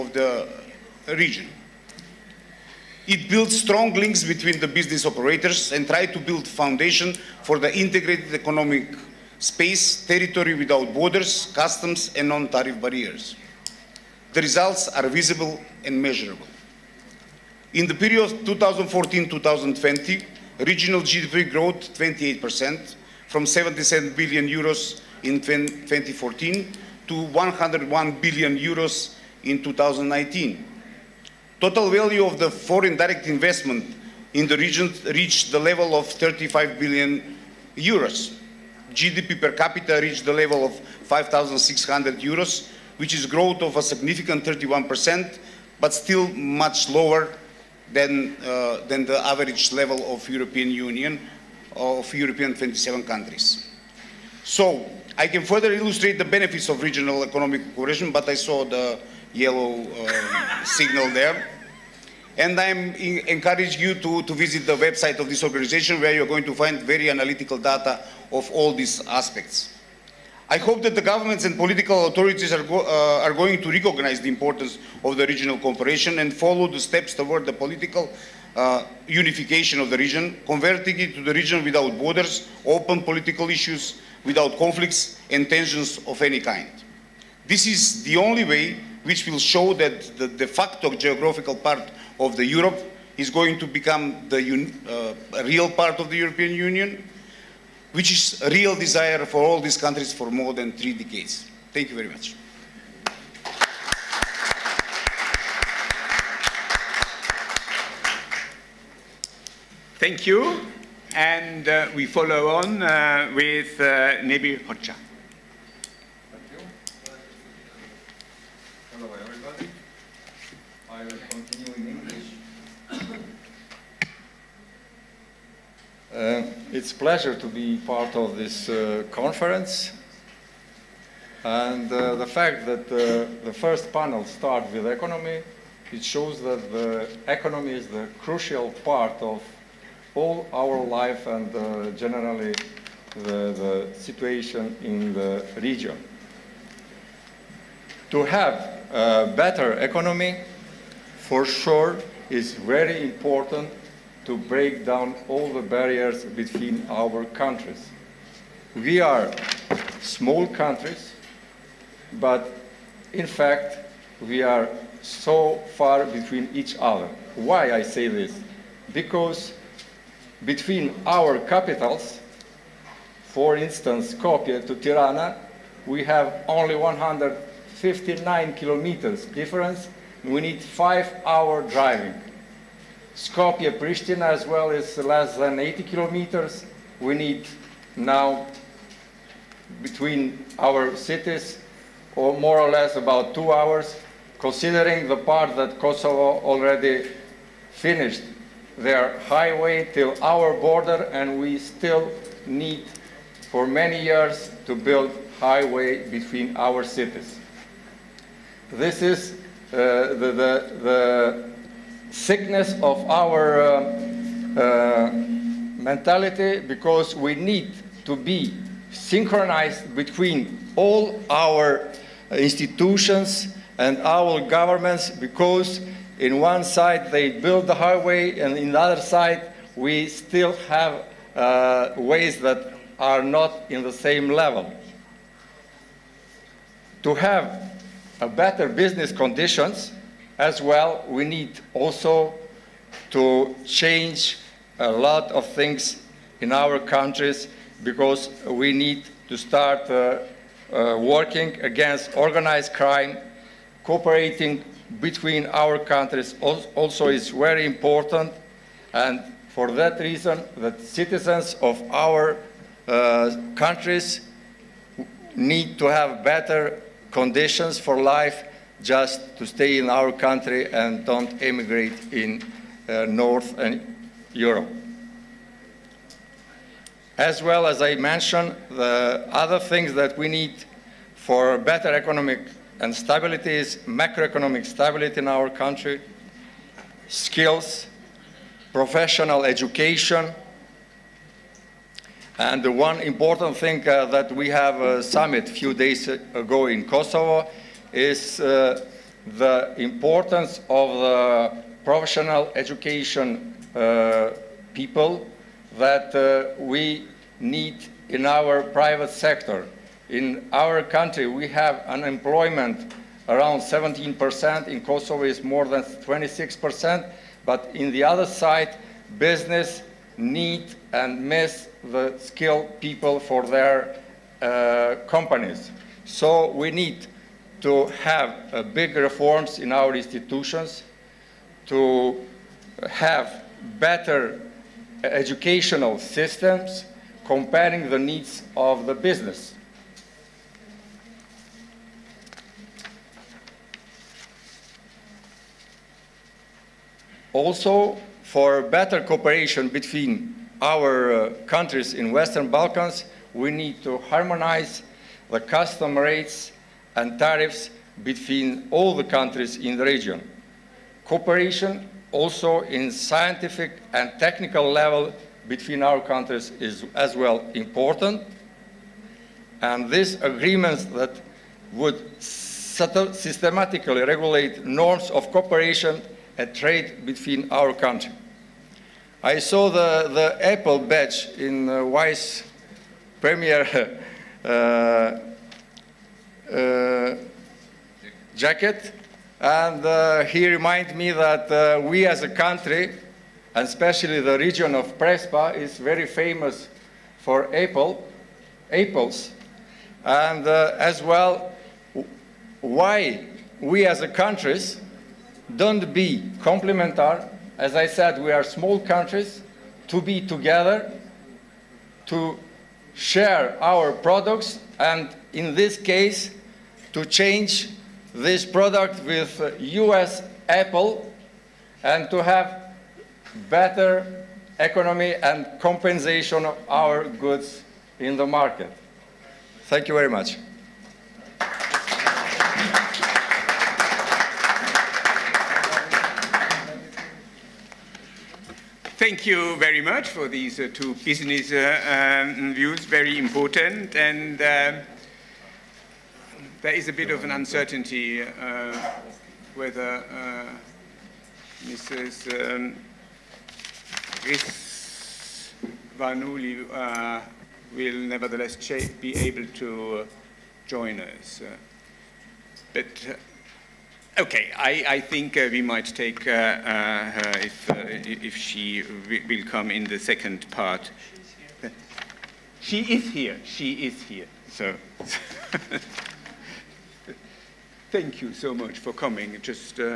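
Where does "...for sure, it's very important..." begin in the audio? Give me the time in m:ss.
2:31.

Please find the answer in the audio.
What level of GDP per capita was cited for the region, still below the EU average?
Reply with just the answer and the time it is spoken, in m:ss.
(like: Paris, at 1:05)
5,600 euros, at 0:41.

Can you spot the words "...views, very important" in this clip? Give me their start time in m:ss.
7:22.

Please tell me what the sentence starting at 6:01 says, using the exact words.
Cooperation also in scientific and technical level between our countries is as well important.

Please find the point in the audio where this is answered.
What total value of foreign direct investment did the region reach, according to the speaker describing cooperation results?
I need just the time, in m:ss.
0:36.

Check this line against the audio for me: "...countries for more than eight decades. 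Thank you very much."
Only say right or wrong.
wrong.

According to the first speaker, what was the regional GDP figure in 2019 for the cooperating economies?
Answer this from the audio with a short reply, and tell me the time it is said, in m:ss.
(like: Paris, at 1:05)
101 billion euros, at 0:27.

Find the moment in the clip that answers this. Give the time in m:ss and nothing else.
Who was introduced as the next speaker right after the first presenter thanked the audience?
1:54.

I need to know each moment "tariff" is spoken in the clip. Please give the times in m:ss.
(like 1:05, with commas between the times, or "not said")
0:12, 5:57.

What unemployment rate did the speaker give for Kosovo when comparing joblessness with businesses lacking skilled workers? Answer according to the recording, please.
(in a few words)
26%.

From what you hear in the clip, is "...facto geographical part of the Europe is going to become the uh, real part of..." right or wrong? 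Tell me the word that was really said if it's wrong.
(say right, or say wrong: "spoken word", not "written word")
right.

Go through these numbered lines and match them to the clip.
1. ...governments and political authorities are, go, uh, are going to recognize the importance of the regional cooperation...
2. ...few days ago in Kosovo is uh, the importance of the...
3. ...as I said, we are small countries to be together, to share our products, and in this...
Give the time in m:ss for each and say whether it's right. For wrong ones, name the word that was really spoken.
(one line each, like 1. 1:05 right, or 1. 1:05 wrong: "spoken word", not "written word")
1. 1:11 right
2. 4:55 right
3. 6:47 right.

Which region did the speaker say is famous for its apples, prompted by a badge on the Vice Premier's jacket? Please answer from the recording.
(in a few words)
Prespa.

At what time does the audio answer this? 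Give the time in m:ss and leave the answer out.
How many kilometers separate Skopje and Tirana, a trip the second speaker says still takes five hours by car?
2:56.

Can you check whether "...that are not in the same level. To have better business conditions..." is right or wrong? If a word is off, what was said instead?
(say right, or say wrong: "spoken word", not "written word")
right.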